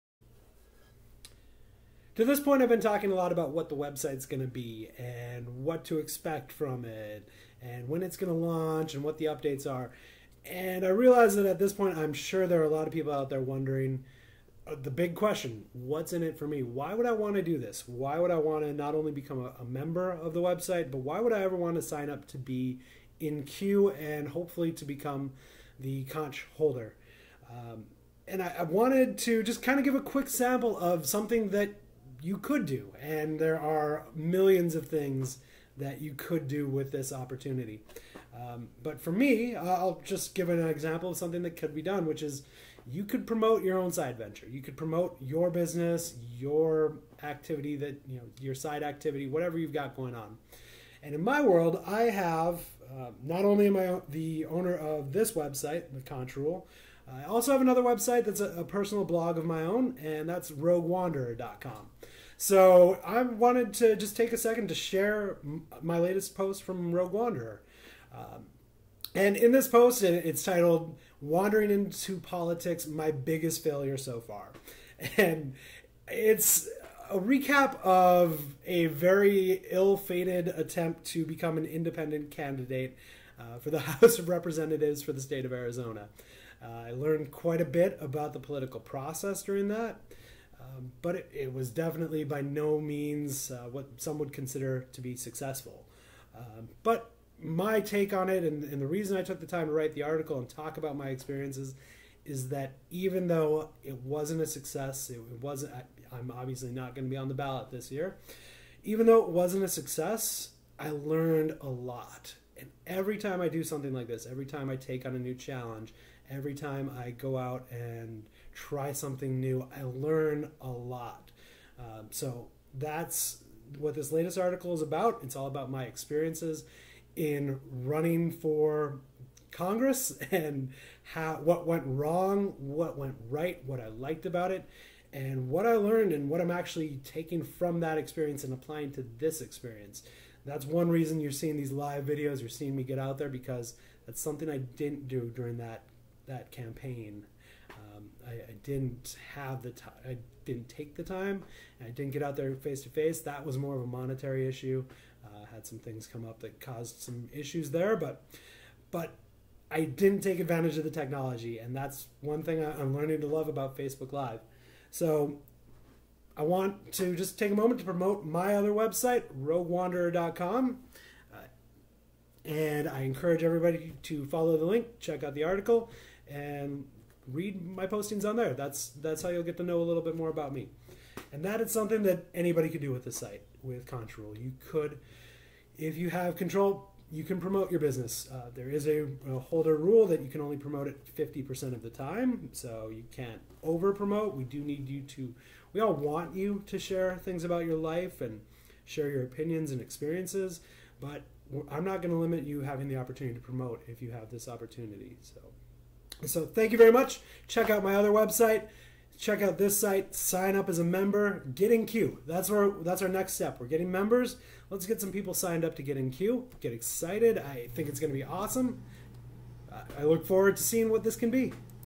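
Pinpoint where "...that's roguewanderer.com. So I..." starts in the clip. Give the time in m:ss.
1:00.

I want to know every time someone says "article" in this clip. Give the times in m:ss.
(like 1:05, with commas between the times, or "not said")
1:40, 2:04, 2:55.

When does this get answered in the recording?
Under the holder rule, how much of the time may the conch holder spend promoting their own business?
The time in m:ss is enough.
3:11.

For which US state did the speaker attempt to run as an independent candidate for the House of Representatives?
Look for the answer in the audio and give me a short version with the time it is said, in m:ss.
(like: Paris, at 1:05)
Arizona, at 1:25.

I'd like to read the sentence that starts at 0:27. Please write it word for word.
Um, and I, I wanted to just kind of give a quick sample of something that you could do.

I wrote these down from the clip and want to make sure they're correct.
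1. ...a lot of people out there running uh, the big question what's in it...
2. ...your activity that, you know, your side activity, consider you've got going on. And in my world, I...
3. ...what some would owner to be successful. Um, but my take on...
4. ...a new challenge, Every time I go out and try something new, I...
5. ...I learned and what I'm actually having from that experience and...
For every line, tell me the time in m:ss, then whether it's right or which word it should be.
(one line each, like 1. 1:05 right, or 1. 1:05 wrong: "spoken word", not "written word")
1. 0:12 wrong: "wondering", not "running"
2. 0:46 wrong: "whatever", not "consider"
3. 1:33 wrong: "consider", not "owner"
4. 1:55 right
5. 2:15 wrong: "taking", not "having".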